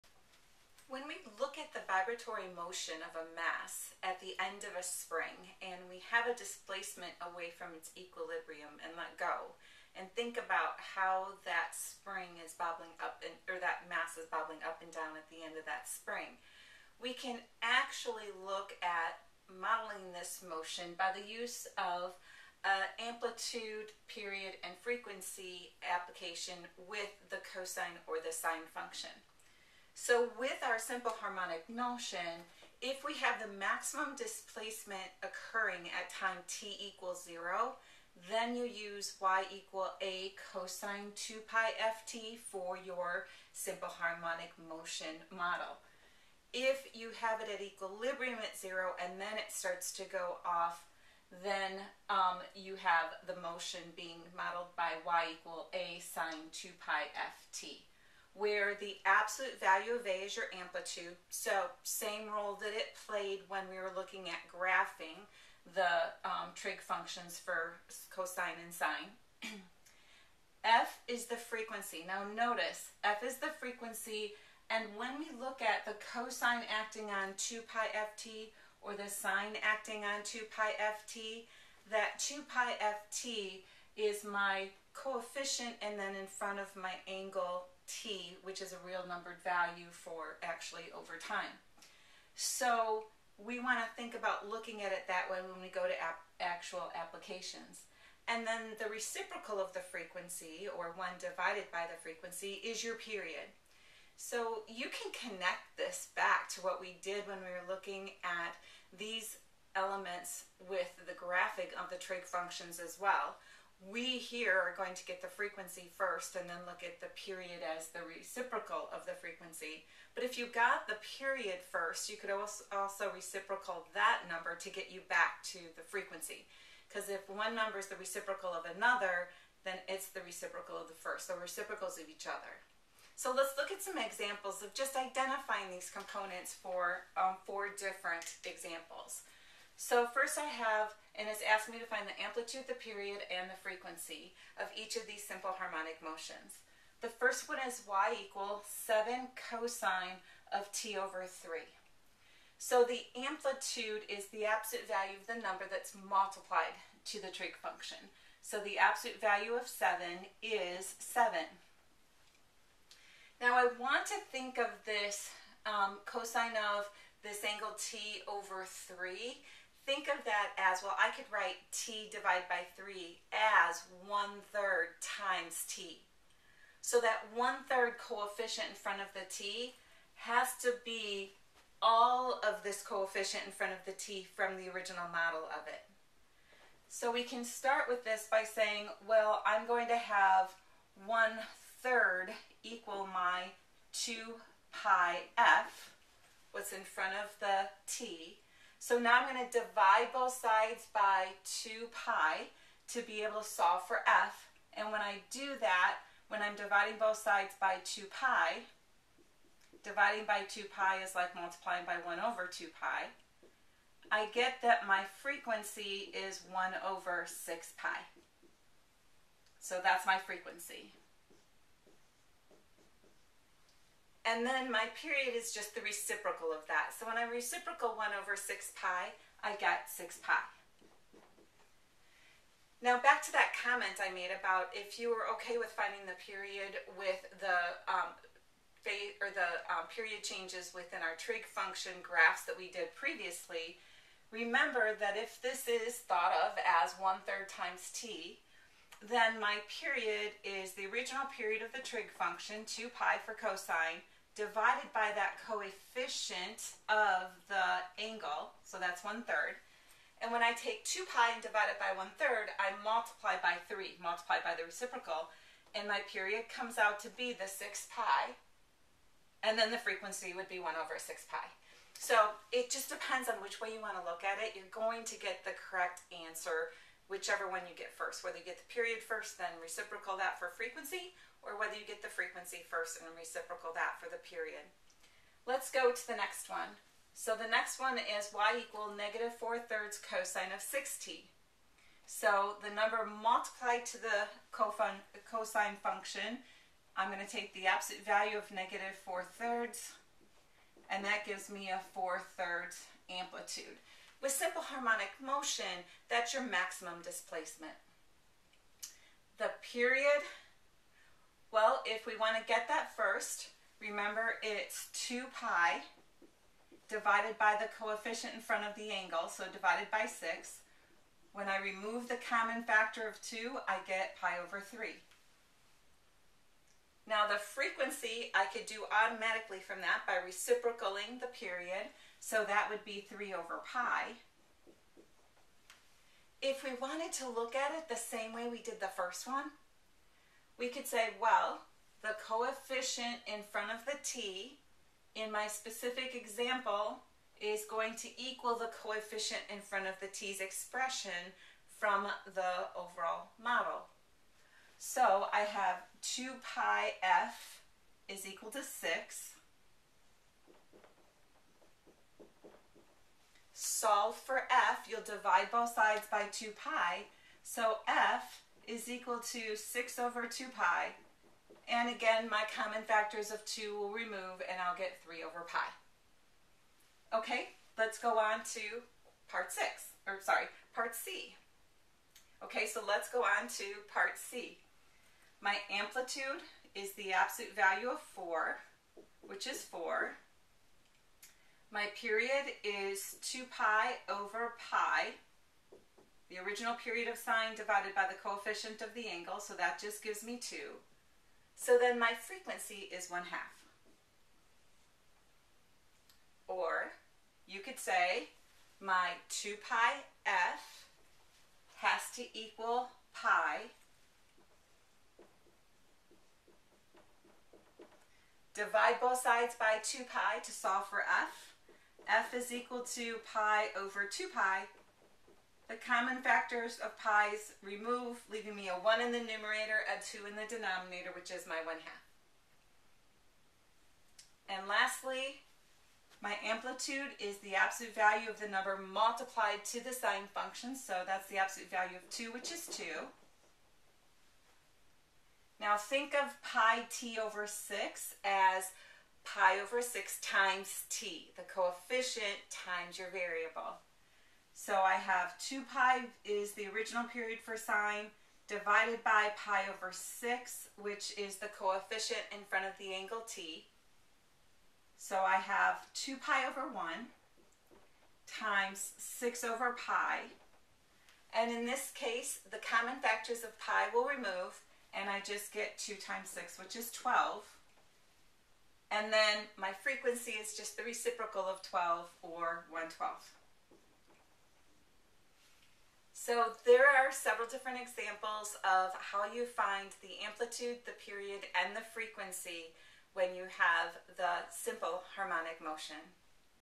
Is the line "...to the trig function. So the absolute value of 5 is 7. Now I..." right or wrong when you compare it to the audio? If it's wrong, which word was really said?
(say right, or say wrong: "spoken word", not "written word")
wrong: "7", not "5".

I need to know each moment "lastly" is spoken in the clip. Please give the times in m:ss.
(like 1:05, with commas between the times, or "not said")
7:14.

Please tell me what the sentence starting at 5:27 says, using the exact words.
Now the frequency I could do automatically from that by reciprocaling the period, so that would be 3 over pi.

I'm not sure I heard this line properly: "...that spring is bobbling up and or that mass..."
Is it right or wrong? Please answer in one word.
right.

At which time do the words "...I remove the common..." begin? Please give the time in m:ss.
5:21.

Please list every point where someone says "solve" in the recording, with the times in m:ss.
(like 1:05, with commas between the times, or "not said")
3:23, 6:03, 7:00.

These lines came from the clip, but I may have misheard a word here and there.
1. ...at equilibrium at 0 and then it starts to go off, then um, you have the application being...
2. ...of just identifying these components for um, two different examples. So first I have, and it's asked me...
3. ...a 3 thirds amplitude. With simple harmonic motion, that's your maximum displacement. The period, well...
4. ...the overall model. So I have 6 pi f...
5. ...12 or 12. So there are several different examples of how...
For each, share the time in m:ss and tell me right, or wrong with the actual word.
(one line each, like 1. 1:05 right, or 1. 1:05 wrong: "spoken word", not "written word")
1. 0:47 wrong: "motion", not "application"
2. 2:14 wrong: "four", not "two"
3. 5:01 wrong: "4", not "3"
4. 5:52 wrong: "2", not "6"
5. 8:01 right.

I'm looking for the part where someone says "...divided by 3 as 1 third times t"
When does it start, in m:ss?
2:52.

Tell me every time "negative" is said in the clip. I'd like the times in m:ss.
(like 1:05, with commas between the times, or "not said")
4:48, 4:58.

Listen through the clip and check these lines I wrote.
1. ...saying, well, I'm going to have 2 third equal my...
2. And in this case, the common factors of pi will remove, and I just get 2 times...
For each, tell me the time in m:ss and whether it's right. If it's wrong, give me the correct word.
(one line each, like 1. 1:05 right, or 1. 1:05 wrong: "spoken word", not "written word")
1. 3:08 wrong: "1", not "2"
2. 7:51 right.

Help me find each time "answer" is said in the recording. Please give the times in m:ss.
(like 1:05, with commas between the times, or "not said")
4:36.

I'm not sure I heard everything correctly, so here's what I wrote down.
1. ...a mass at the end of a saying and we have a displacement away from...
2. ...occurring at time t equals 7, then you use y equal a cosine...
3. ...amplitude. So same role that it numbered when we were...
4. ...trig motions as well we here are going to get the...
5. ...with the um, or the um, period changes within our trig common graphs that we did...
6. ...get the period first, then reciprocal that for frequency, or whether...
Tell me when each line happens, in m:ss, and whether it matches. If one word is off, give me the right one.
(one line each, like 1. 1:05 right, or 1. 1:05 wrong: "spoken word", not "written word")
1. 0:03 wrong: "spring", not "saying"
2. 0:35 wrong: "0", not "7"
3. 1:00 wrong: "played", not "numbered"
4. 1:51 wrong: "functions", not "motions"
5. 3:56 wrong: "function", not "common"
6. 4:38 right.